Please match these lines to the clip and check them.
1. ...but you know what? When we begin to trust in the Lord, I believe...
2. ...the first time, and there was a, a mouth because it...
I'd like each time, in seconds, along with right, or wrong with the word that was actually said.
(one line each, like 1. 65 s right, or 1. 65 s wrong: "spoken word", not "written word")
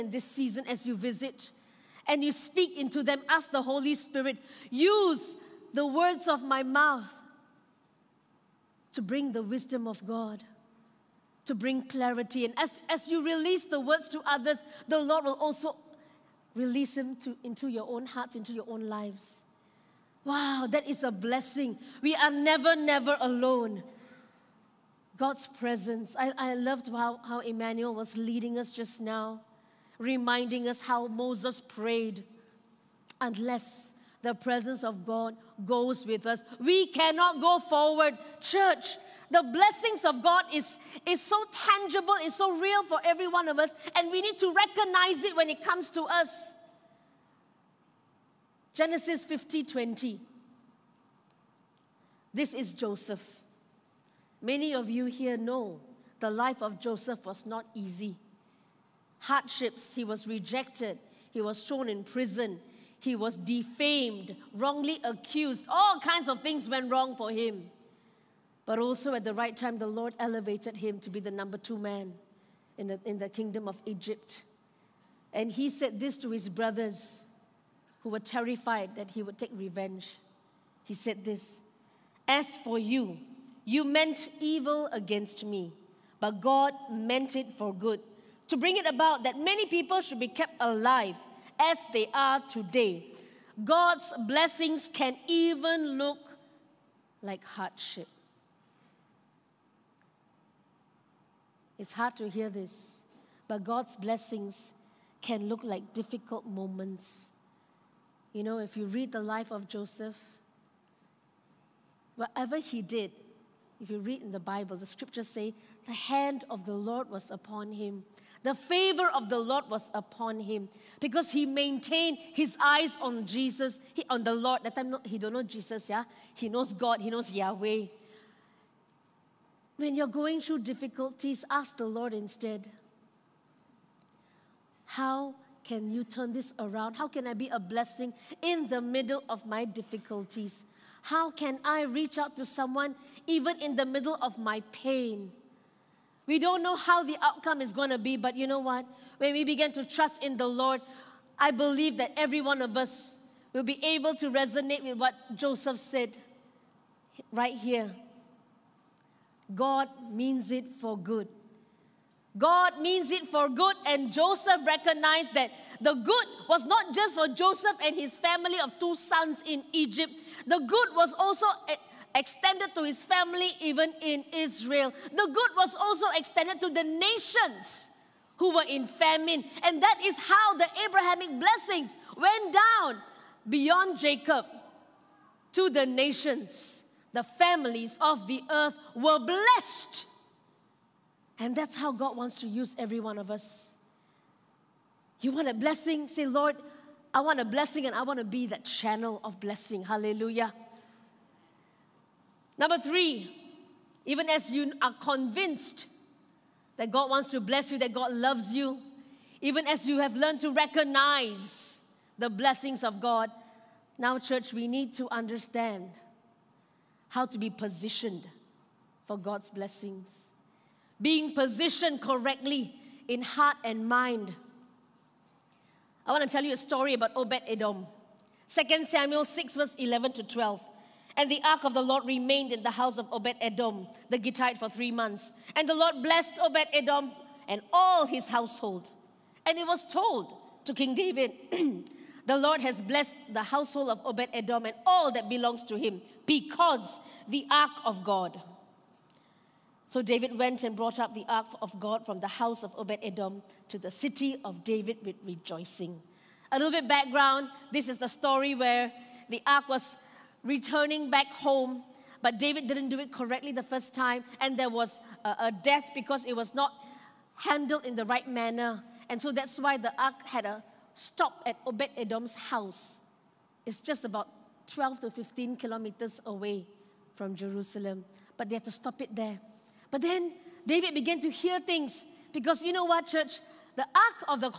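1. 148 s right
2. 263 s wrong: "death", not "mouth".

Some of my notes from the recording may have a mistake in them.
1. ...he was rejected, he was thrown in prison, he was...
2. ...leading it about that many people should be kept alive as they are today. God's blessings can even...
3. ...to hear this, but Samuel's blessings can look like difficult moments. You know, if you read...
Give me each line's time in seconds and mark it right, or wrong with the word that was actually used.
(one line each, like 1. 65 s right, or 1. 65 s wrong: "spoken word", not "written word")
1. 59 s right
2. 88 s wrong: "bring", not "leading"
3. 102 s wrong: "God", not "Samuel".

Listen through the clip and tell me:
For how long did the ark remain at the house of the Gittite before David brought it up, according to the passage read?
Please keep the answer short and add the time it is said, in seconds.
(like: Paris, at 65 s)
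3 months, at 234 s.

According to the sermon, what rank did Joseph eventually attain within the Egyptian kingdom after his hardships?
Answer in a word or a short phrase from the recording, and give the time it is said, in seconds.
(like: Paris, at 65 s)
number two man, at 71 s.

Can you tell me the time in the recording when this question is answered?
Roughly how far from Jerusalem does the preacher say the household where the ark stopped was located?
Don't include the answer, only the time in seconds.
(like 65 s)
274 s.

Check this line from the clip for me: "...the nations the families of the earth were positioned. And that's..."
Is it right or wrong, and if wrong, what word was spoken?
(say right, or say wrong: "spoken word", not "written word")
wrong: "blessed", not "positioned".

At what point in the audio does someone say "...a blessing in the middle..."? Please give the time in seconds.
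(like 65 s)
137 s.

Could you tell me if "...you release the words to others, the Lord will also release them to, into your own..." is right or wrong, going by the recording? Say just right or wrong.
right.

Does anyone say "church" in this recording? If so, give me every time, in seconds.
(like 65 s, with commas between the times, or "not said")
38 s, 214 s, 283 s.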